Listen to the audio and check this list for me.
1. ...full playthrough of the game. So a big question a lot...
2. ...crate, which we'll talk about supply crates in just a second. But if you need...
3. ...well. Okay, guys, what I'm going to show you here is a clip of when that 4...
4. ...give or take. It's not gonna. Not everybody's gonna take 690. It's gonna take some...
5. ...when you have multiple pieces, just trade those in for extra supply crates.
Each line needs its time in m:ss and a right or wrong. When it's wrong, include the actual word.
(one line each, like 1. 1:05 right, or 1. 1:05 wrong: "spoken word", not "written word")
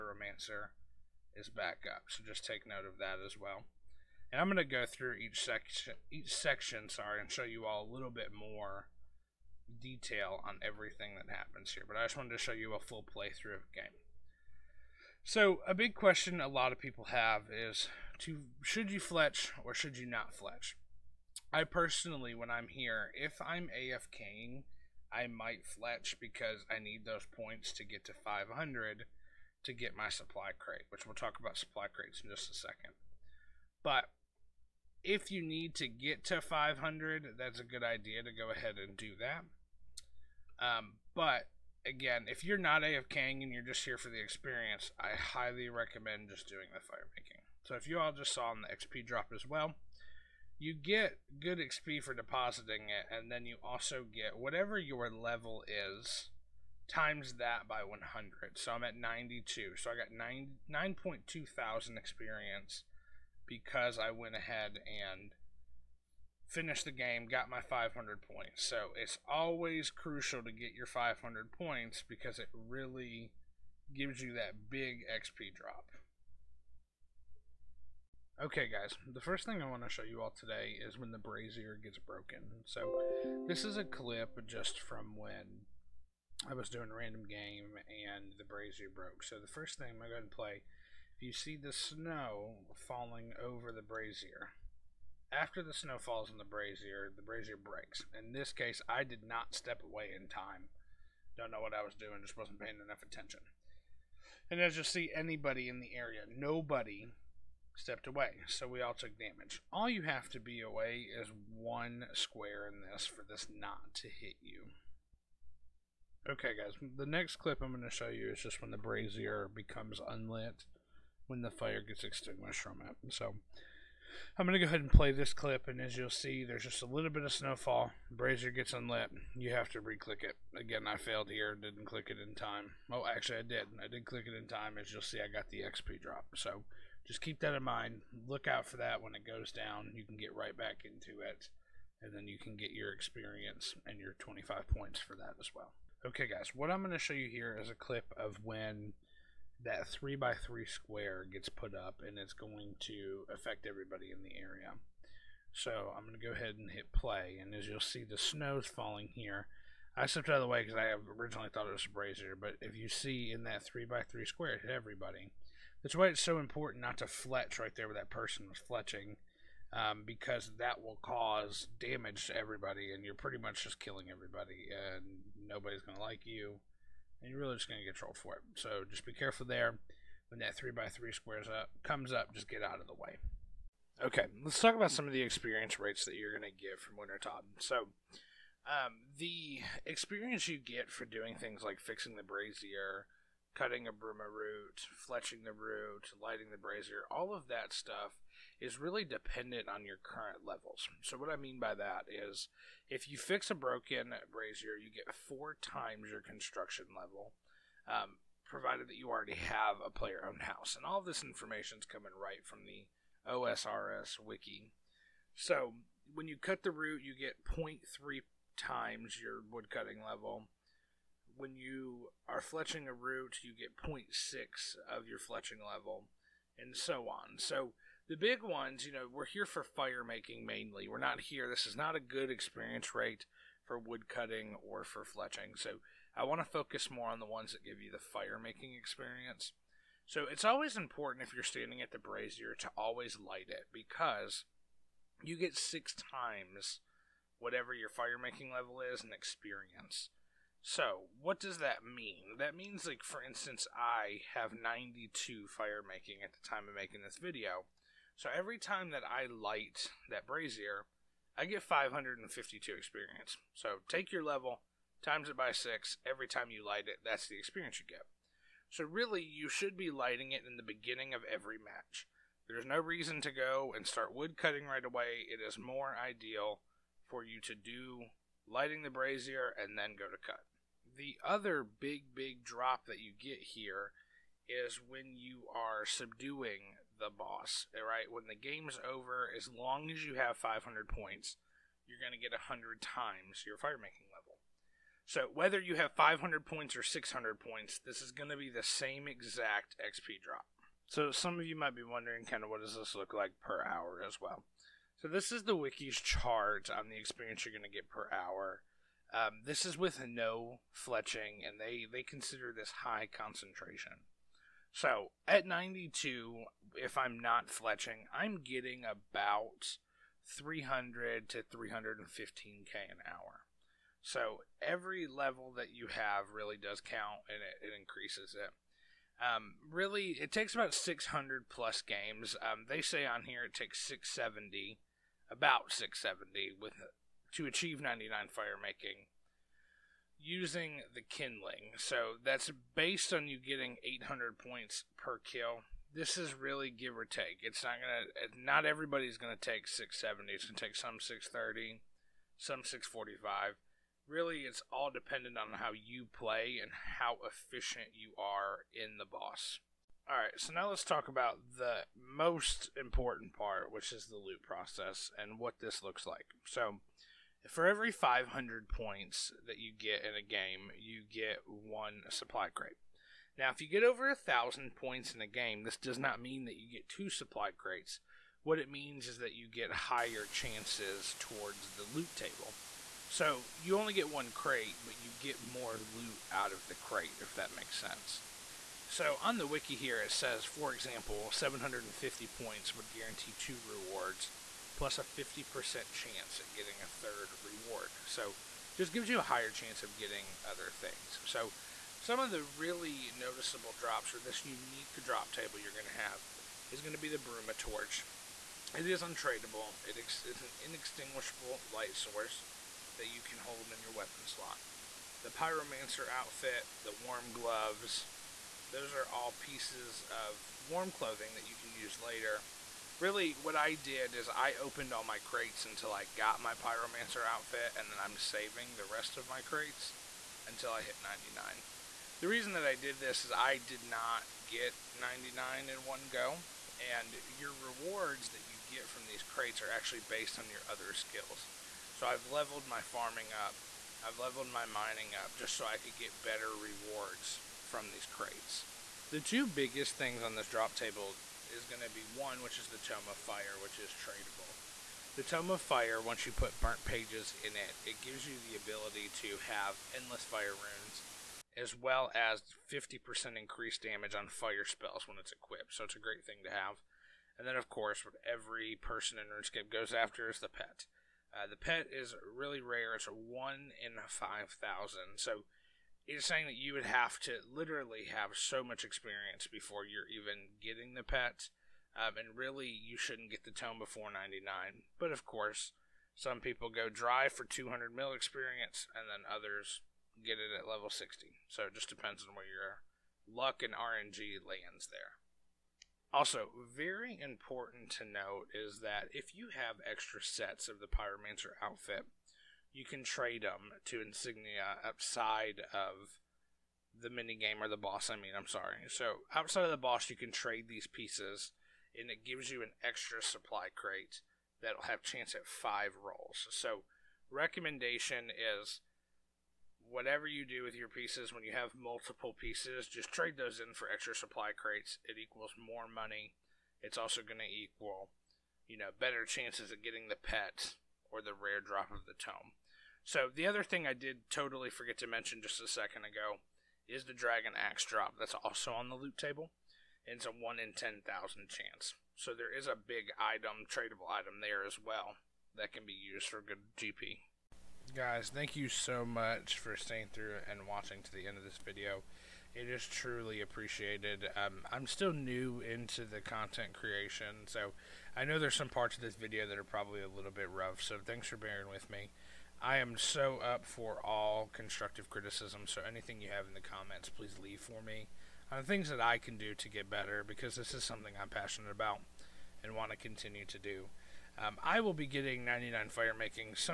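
1. 0:12 right
2. 0:30 right
3. 2:25 wrong: "3", not "4"
4. 5:46 wrong: "670", not "690"
5. 8:41 right.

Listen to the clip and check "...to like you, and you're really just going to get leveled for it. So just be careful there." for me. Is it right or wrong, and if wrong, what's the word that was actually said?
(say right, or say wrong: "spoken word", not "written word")
wrong: "trolled", not "leveled".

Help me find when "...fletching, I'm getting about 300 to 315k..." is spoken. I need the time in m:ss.
5:17.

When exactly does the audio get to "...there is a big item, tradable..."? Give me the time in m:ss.
9:02.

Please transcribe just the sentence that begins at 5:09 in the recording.
Um, this is with no fletching, and they, they consider this high concentration.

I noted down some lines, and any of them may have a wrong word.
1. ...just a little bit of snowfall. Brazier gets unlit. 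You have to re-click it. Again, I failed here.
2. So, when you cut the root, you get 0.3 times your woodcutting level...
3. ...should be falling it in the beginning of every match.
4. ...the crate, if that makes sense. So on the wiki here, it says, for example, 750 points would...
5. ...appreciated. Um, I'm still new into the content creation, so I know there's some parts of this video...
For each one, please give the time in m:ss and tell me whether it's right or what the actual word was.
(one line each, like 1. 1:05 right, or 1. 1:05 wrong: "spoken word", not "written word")
1. 2:06 right
2. 3:35 right
3. 4:29 wrong: "lighting", not "falling"
4. 6:26 right
5. 9:13 right.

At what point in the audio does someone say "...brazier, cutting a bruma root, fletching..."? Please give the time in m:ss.
3:12.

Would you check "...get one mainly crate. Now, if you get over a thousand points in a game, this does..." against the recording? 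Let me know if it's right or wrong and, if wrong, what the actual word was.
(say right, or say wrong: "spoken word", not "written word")
wrong: "supply", not "mainly".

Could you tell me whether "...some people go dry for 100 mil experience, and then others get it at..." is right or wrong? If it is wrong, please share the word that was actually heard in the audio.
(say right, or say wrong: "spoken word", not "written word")
wrong: "200", not "100".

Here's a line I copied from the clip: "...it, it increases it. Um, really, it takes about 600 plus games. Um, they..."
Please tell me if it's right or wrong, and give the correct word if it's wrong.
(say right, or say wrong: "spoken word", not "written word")
right.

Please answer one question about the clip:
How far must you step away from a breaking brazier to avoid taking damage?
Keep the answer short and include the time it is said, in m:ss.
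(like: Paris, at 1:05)
One square, at 1:51.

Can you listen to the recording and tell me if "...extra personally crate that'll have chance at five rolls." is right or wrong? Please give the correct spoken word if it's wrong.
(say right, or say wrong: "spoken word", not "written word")
wrong: "supply", not "personally".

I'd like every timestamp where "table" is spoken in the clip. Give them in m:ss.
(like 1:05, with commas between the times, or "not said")
6:22, 6:45, 7:30, 8:59.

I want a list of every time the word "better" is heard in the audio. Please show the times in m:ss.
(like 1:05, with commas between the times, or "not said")
7:26, 8:48, 9:29.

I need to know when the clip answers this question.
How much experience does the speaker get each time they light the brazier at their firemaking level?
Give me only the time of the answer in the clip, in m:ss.
4:21.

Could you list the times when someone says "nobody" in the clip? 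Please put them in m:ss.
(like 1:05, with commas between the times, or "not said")
1:46, 2:55.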